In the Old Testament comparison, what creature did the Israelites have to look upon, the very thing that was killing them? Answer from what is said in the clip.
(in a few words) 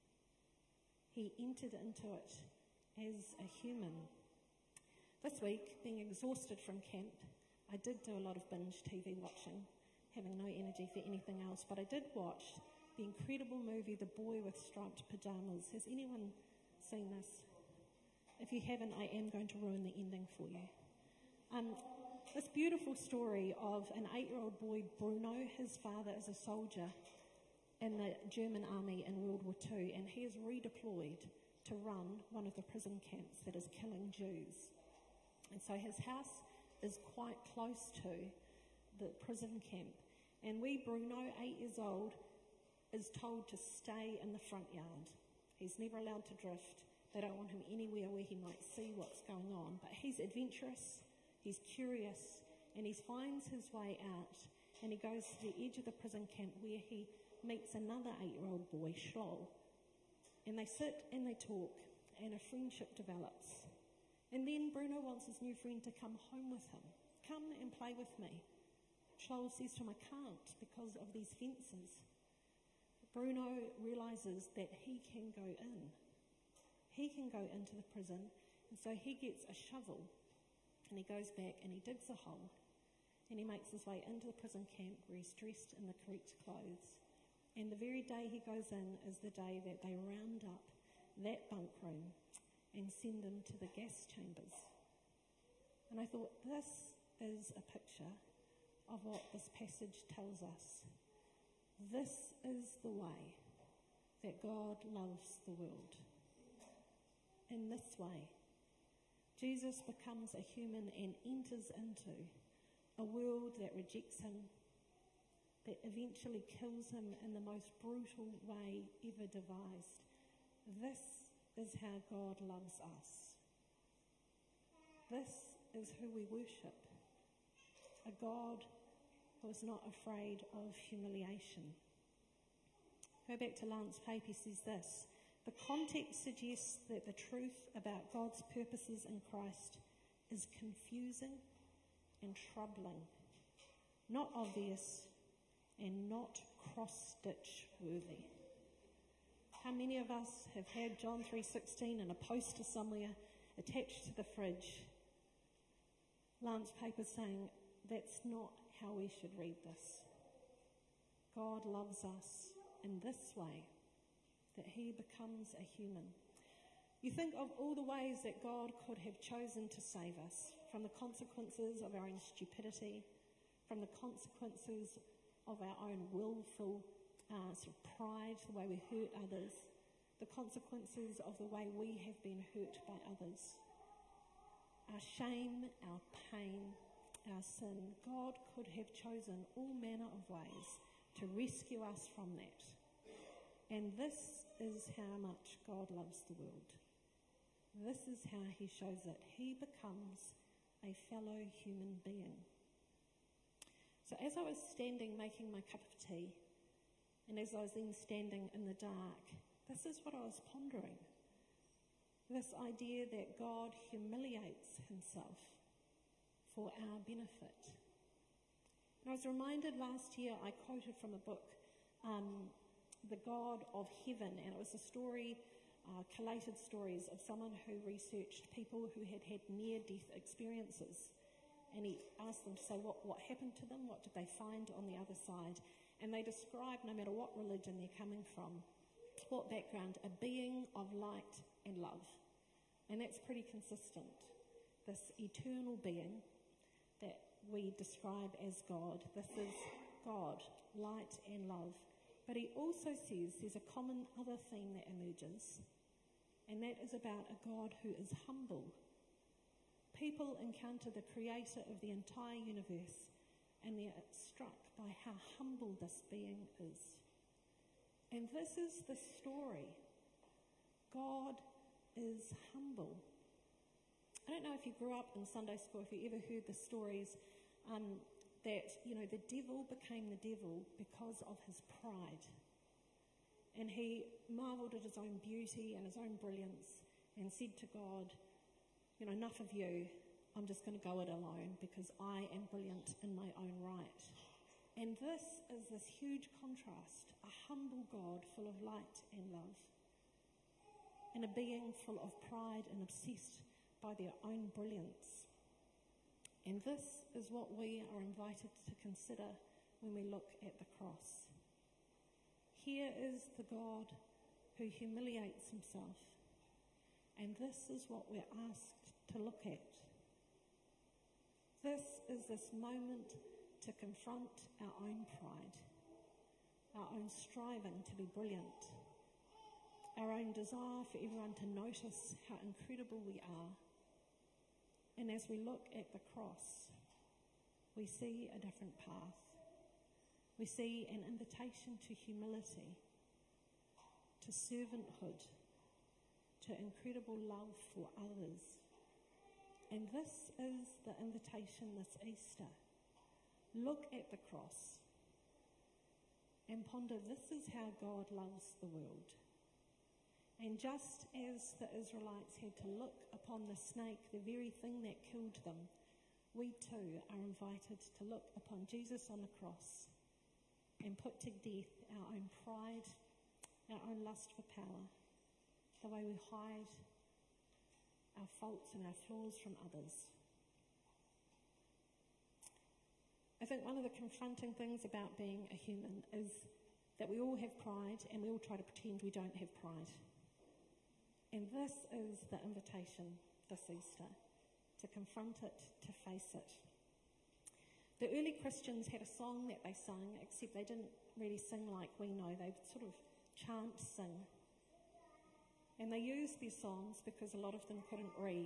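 snake.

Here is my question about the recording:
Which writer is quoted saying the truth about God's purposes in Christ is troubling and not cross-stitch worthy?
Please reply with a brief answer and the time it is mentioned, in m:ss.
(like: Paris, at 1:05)
Lance Pape, at 2:13.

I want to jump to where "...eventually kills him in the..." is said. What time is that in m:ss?
1:55.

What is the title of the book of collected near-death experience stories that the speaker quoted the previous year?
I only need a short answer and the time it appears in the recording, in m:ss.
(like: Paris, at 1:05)
The God of Heaven, at 3:43.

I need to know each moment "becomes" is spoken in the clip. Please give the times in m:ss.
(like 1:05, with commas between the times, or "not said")
1:49, 2:44, 3:19.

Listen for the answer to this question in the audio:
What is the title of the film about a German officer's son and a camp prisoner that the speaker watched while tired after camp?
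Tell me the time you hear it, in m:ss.
0:13.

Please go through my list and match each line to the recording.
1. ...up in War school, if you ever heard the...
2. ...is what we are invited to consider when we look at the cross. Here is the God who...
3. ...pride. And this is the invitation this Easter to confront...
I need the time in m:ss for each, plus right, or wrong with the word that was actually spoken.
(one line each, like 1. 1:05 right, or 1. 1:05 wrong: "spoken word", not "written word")
1. 4:34 wrong: "Sunday", not "War"
2. 5:07 right
3. 6:29 right.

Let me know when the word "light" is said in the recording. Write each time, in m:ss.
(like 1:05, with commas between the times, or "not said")
4:00, 4:10, 4:58.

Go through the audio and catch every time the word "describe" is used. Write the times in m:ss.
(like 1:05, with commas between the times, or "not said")
3:56, 4:07.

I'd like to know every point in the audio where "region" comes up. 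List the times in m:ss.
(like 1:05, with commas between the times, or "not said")
not said.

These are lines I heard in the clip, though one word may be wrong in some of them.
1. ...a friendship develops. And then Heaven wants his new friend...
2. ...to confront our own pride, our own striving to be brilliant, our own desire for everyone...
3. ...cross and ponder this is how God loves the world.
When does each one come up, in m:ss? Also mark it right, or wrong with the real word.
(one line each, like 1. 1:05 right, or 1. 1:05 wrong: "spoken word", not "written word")
1. 1:02 wrong: "Bruno", not "Heaven"
2. 5:23 right
3. 5:54 right.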